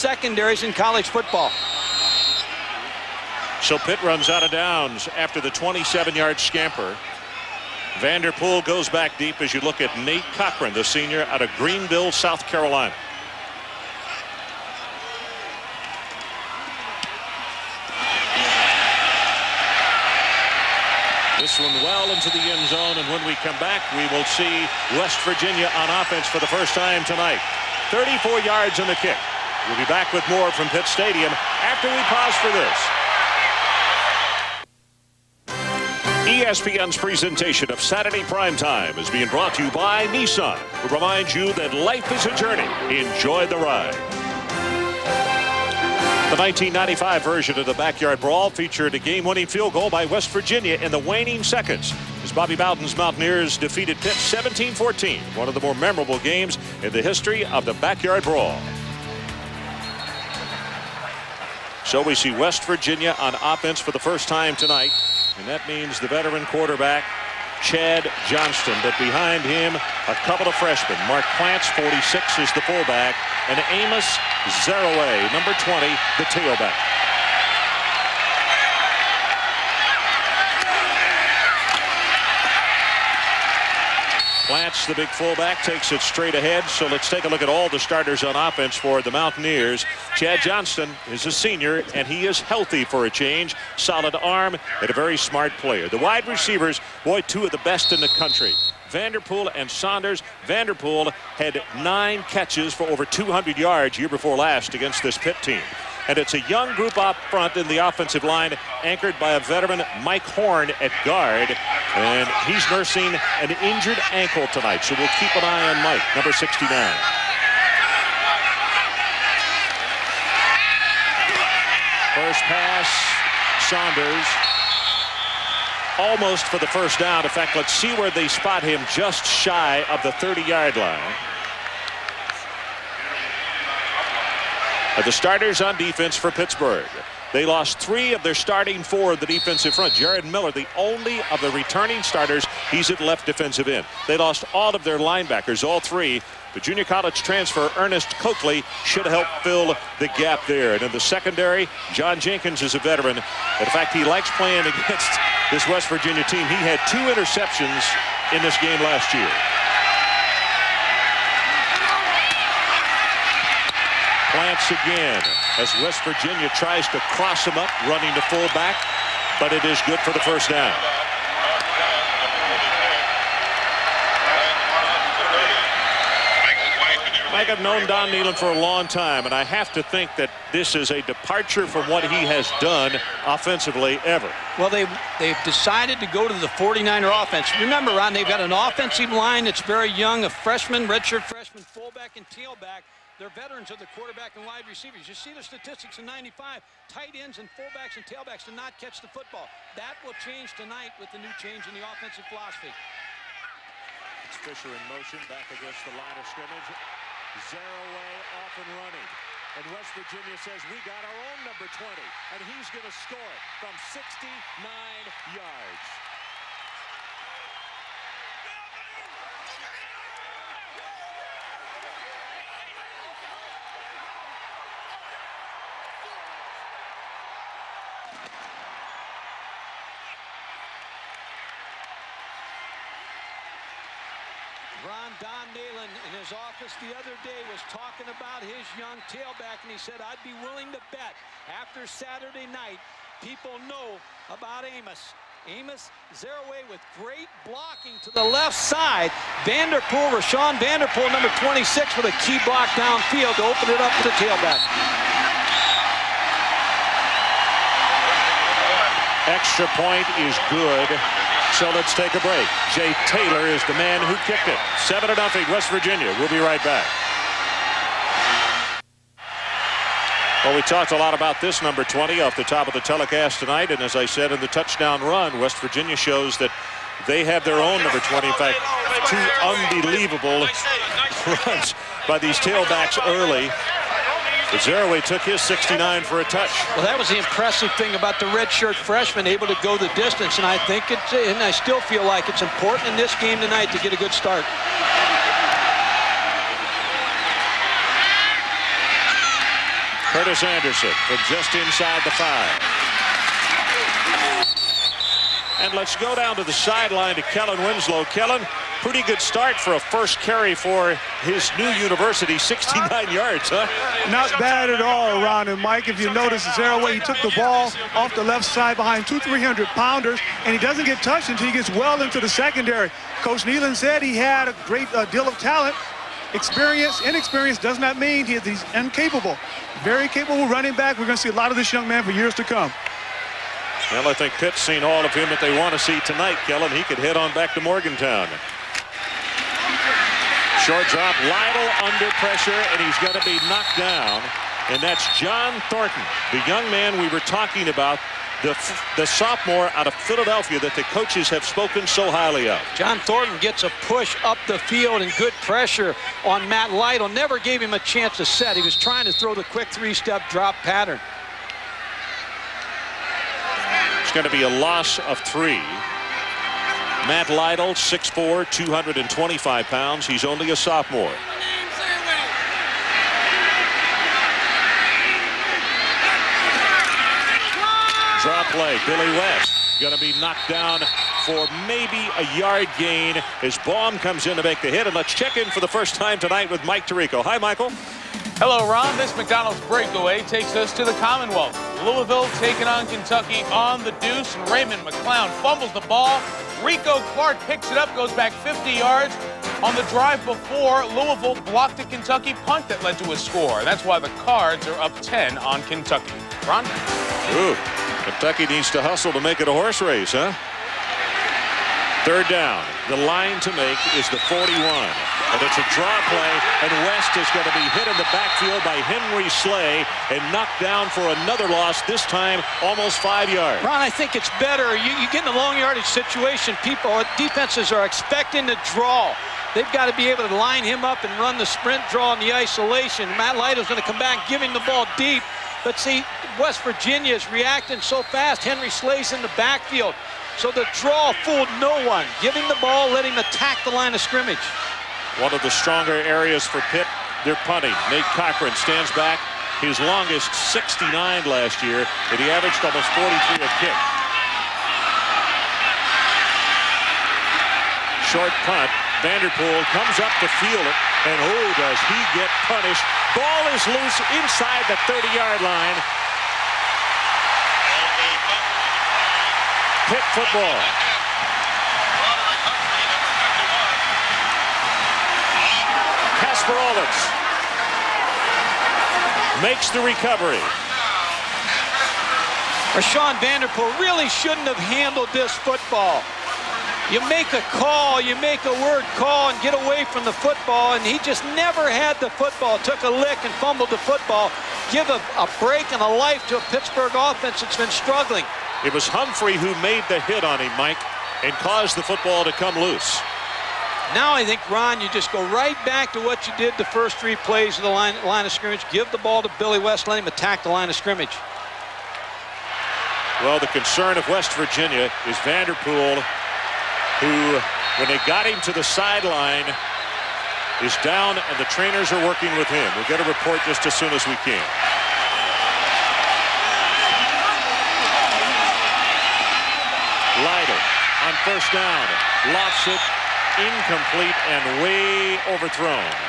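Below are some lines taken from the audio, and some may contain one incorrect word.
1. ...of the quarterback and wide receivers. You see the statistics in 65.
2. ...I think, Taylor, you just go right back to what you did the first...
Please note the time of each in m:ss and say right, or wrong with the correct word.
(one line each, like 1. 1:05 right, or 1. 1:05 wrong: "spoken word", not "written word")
1. 3:13 wrong: "95", not "65"
2. 8:24 wrong: "Ron", not "Taylor".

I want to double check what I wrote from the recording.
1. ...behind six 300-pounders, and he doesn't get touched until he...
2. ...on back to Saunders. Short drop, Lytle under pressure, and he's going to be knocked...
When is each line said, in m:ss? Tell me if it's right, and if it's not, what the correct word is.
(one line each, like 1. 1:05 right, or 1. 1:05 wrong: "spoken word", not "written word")
1. 5:18 wrong: "two", not "six"
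2. 5:37 wrong: "Morgantown", not "Saunders".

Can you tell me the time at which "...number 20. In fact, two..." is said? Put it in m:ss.
4:37.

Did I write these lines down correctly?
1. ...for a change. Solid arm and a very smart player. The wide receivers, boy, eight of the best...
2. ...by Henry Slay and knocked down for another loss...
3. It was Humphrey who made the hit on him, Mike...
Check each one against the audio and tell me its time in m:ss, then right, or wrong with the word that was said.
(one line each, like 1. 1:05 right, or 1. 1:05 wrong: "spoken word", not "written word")
1. 1:32 wrong: "two", not "eight"
2. 6:58 right
3. 8:18 right.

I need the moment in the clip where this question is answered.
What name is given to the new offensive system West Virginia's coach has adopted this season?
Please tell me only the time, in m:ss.
3:06.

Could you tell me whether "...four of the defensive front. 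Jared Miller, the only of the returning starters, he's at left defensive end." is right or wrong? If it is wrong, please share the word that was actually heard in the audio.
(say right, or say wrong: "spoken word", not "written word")
right.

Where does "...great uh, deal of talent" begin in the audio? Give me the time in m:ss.
5:24.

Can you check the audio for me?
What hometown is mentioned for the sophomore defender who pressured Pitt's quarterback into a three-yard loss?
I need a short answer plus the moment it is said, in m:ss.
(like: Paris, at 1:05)
Philadelphia, at 5:49.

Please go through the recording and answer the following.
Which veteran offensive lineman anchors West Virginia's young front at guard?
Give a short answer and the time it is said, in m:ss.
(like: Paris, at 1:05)
Mike Horn, at 1:50.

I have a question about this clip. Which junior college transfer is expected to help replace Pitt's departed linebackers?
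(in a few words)
Ernest Coakley.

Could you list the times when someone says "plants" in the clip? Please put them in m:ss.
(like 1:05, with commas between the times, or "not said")
1:11, 2:44.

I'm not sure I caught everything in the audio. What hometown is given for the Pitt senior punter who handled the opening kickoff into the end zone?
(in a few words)
Greenville, South Carolina.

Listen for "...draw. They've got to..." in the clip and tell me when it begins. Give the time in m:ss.
7:08.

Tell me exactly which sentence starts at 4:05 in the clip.
Amos Zereoué with great blocking to the left side.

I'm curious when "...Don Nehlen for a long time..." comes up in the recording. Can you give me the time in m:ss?
2:57.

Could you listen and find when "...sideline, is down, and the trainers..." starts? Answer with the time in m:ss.
8:38.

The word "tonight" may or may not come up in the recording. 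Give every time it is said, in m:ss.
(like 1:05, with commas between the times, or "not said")
0:27, 1:04, 1:54, 3:20, 4:33, 4:53, 5:36, 6:26.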